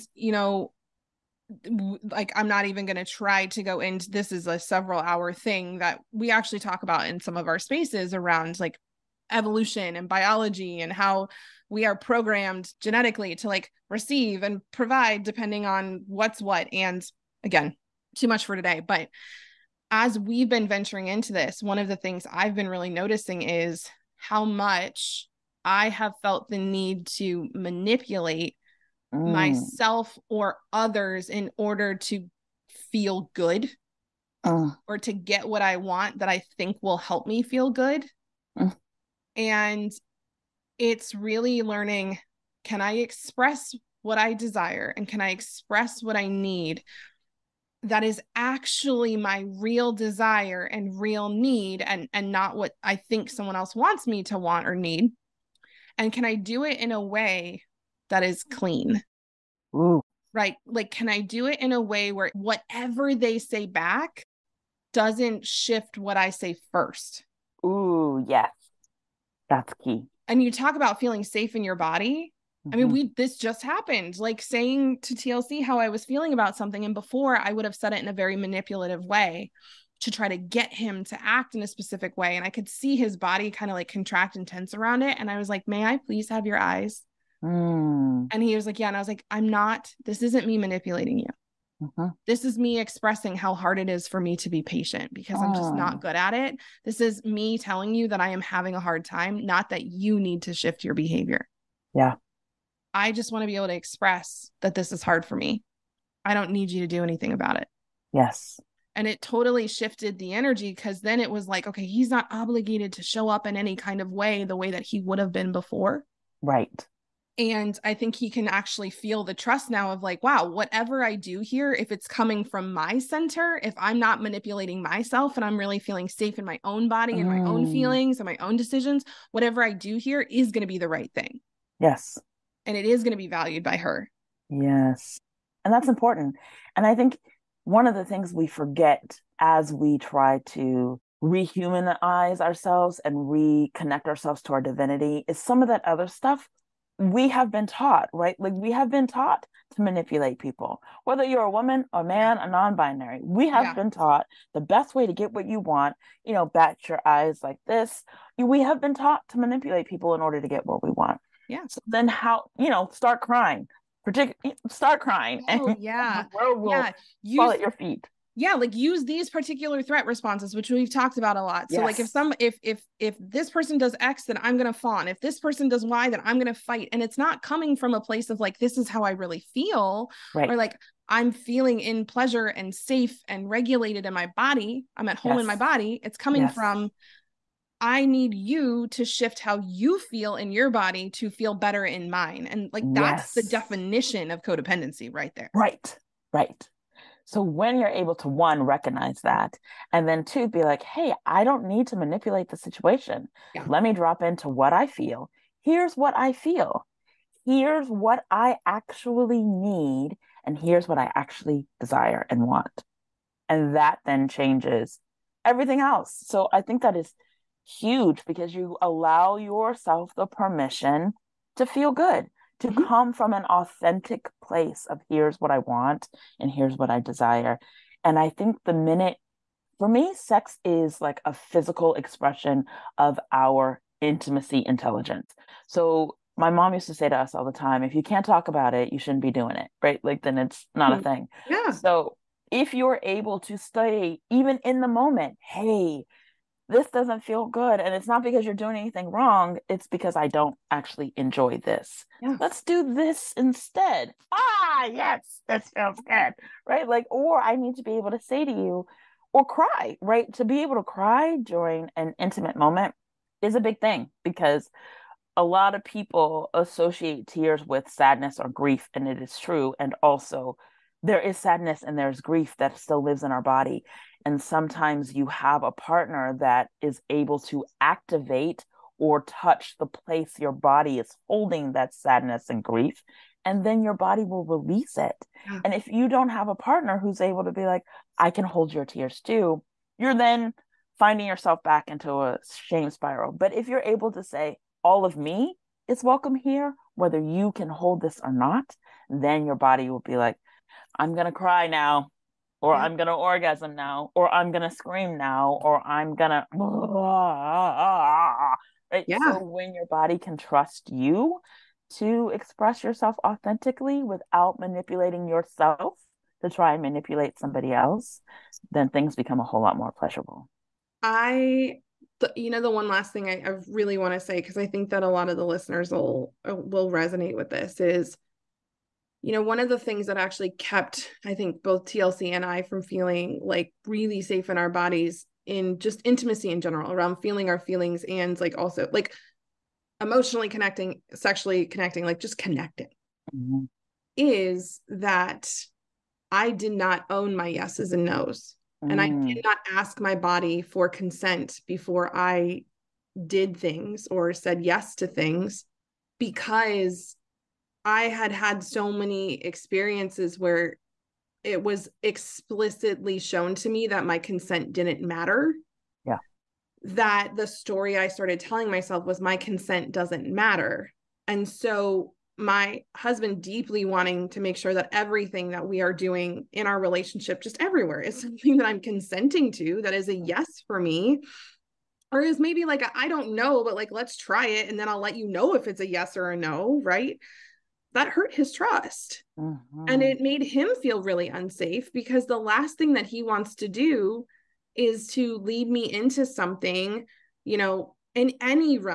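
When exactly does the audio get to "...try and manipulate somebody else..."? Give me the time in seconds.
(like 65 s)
316 s.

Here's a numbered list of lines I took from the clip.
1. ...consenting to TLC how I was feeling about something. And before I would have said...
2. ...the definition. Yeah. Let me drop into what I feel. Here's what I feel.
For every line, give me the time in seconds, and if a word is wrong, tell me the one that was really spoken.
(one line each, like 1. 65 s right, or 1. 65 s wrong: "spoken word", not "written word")
1. 74 s wrong: "saying", not "consenting"
2. 202 s wrong: "situation", not "definition".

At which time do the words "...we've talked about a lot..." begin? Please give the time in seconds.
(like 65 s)
170 s.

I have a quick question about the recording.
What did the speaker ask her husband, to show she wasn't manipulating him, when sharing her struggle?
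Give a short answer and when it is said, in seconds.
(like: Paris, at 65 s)
May I please have your eyes?, at 85 s.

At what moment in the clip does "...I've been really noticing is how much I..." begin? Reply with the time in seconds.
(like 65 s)
22 s.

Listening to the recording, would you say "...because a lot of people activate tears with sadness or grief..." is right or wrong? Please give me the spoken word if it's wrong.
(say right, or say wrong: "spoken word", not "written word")
wrong: "associate", not "activate".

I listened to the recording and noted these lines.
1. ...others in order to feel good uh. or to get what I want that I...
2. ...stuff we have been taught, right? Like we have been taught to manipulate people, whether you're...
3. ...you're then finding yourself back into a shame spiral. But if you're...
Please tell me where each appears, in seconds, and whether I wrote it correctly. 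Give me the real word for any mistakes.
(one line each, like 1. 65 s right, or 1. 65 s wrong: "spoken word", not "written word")
1. 30 s right
2. 146 s right
3. 289 s right.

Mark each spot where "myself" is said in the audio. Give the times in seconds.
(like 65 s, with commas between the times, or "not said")
29 s, 124 s, 368 s.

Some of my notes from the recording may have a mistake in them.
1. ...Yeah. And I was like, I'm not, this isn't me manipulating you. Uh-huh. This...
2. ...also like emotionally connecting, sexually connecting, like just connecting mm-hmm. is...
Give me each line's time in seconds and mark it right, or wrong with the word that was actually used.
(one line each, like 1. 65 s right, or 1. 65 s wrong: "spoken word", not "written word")
1. 88 s right
2. 338 s right.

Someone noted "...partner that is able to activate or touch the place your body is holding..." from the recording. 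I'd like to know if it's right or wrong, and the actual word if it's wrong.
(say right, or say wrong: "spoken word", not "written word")
right.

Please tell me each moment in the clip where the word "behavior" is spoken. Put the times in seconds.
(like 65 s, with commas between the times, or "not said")
100 s.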